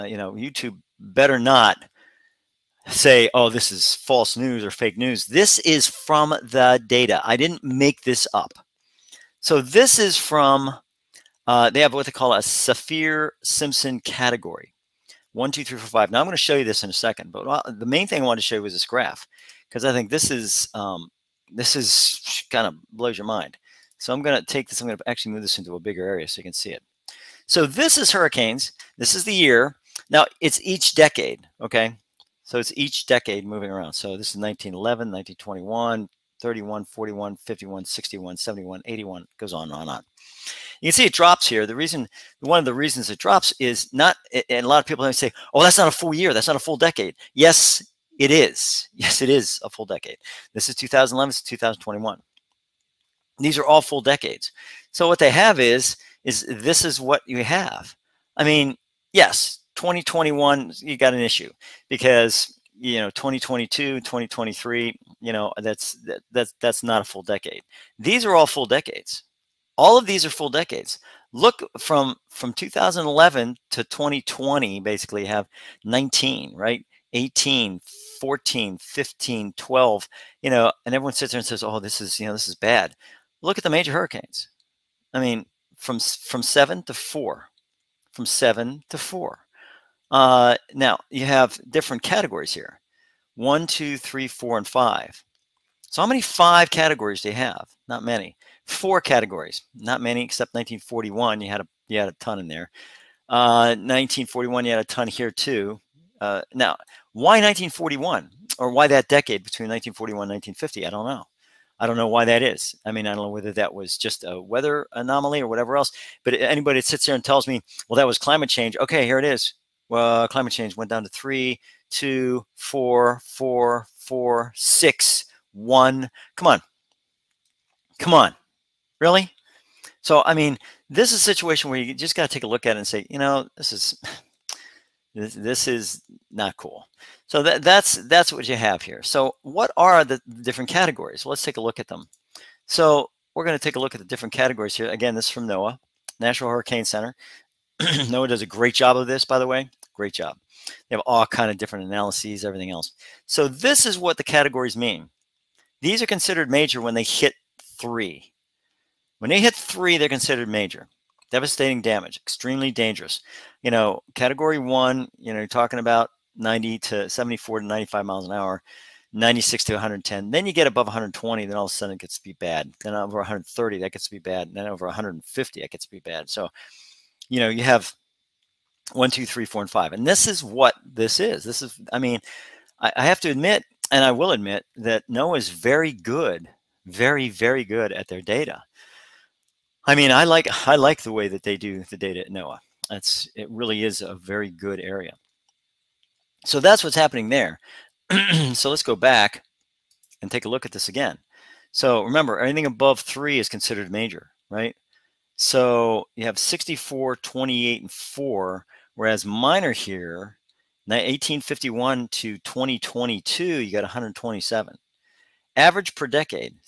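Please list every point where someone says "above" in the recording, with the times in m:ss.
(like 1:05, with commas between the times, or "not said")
2:50, 3:22.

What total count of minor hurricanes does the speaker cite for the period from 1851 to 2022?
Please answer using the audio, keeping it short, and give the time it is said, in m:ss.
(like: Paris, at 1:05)
127, at 3:33.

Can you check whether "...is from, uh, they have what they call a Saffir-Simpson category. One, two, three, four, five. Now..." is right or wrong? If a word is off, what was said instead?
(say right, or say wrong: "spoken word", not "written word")
right.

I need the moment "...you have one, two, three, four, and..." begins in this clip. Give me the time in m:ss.
2:57.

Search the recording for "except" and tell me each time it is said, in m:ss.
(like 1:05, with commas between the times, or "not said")
1:40.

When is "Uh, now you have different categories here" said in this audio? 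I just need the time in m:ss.
1:30.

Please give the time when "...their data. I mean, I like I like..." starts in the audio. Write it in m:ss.
3:08.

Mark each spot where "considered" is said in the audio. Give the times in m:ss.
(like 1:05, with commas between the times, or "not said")
2:36, 2:40, 3:23.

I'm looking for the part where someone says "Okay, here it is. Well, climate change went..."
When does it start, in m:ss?
1:58.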